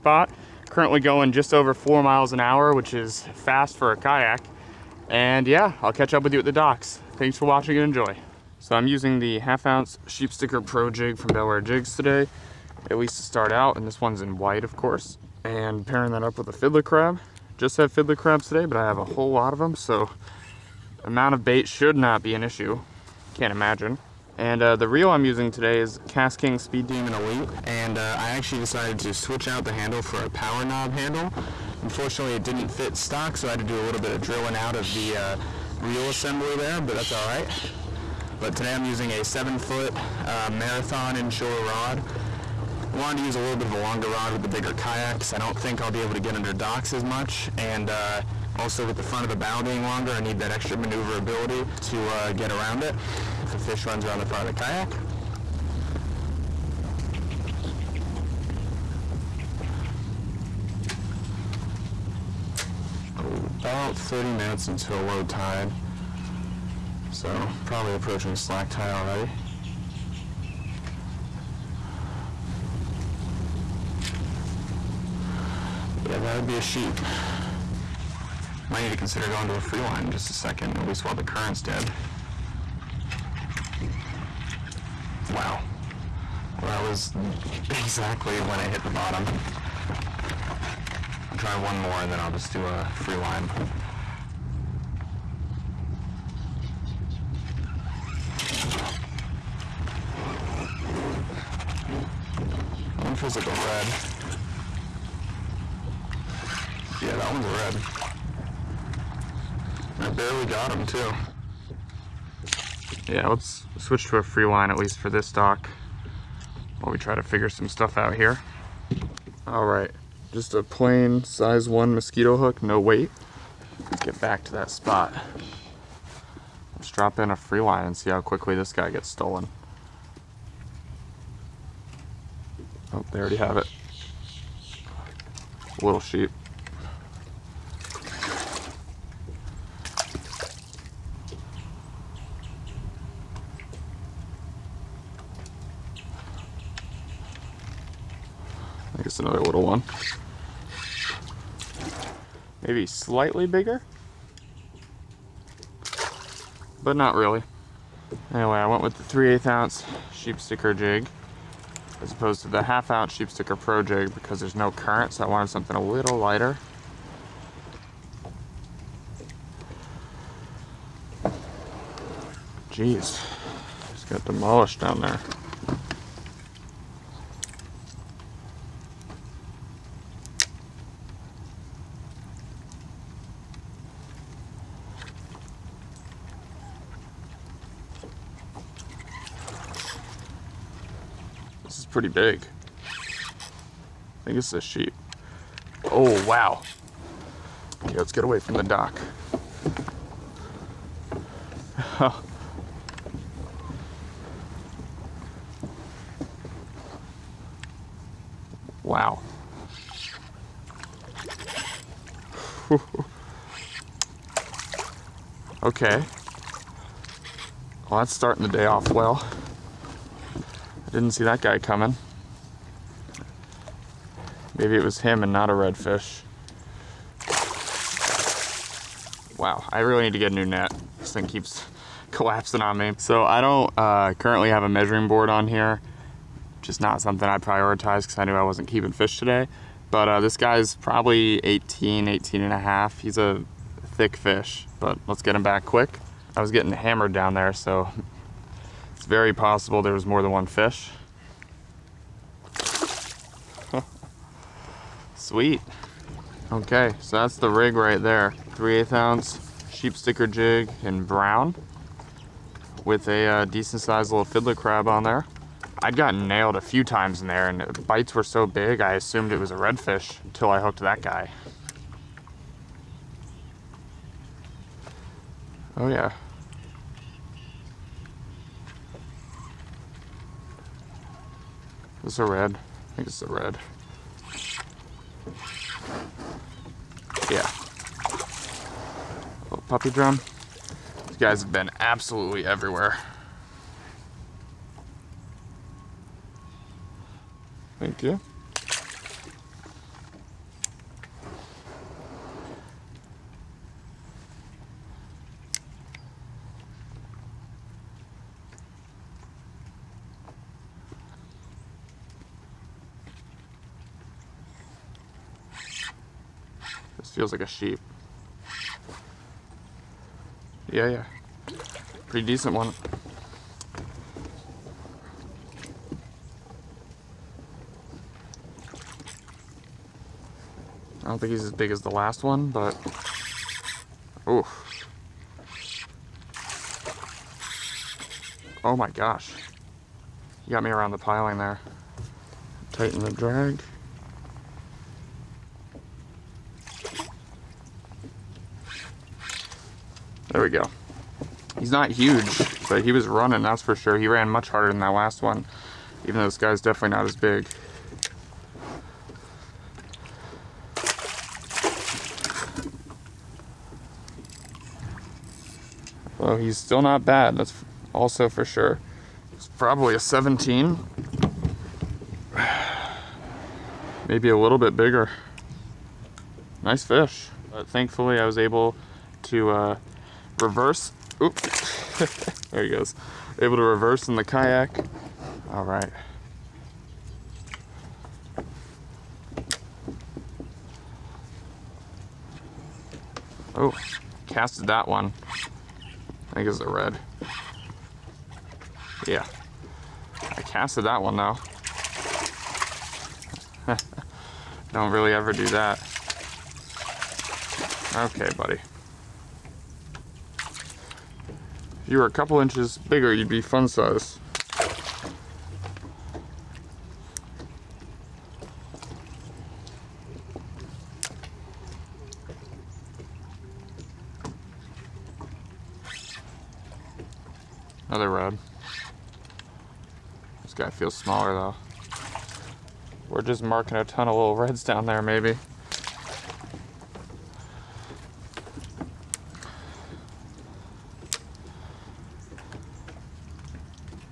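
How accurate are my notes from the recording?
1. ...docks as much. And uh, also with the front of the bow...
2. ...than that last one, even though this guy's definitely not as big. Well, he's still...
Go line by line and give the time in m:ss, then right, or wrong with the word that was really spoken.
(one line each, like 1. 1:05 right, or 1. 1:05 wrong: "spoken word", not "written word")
1. 0:46 right
2. 5:54 right.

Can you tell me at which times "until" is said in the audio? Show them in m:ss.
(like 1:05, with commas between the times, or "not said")
1:04, 4:30.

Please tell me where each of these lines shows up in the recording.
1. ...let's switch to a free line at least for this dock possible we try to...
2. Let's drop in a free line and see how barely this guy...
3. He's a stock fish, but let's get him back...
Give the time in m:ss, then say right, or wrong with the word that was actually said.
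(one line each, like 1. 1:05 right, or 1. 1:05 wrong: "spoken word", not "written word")
1. 1:53 wrong: "while", not "possible"
2. 2:06 wrong: "quickly", not "barely"
3. 4:03 wrong: "thick", not "stock".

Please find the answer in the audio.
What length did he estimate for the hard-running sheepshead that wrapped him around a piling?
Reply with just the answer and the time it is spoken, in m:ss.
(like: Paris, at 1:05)
17, at 6:09.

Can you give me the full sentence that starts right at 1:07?
So probably approaching slack tide already.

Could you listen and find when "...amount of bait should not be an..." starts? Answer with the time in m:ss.
0:21.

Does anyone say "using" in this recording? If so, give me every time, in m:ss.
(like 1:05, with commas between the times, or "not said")
0:08, 0:25, 0:38.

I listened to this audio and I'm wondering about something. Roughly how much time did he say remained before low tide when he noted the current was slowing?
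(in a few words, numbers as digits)
30 minutes.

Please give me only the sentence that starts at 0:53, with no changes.
If a fish runs around the front of the kayak.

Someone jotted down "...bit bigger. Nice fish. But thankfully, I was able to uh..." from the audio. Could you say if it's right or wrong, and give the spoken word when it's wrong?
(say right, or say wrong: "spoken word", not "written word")
right.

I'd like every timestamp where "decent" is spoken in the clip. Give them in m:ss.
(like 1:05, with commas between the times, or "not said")
4:23, 5:22.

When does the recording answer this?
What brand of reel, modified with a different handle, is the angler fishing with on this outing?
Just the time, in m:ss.
0:26.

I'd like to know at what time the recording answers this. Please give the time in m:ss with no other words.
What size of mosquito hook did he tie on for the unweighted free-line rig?
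2:01.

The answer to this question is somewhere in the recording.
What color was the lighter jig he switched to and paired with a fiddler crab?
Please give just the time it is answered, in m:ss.
4:21.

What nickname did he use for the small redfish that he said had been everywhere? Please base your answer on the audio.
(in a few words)
puppy drum.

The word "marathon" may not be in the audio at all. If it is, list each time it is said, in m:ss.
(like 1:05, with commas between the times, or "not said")
0:40.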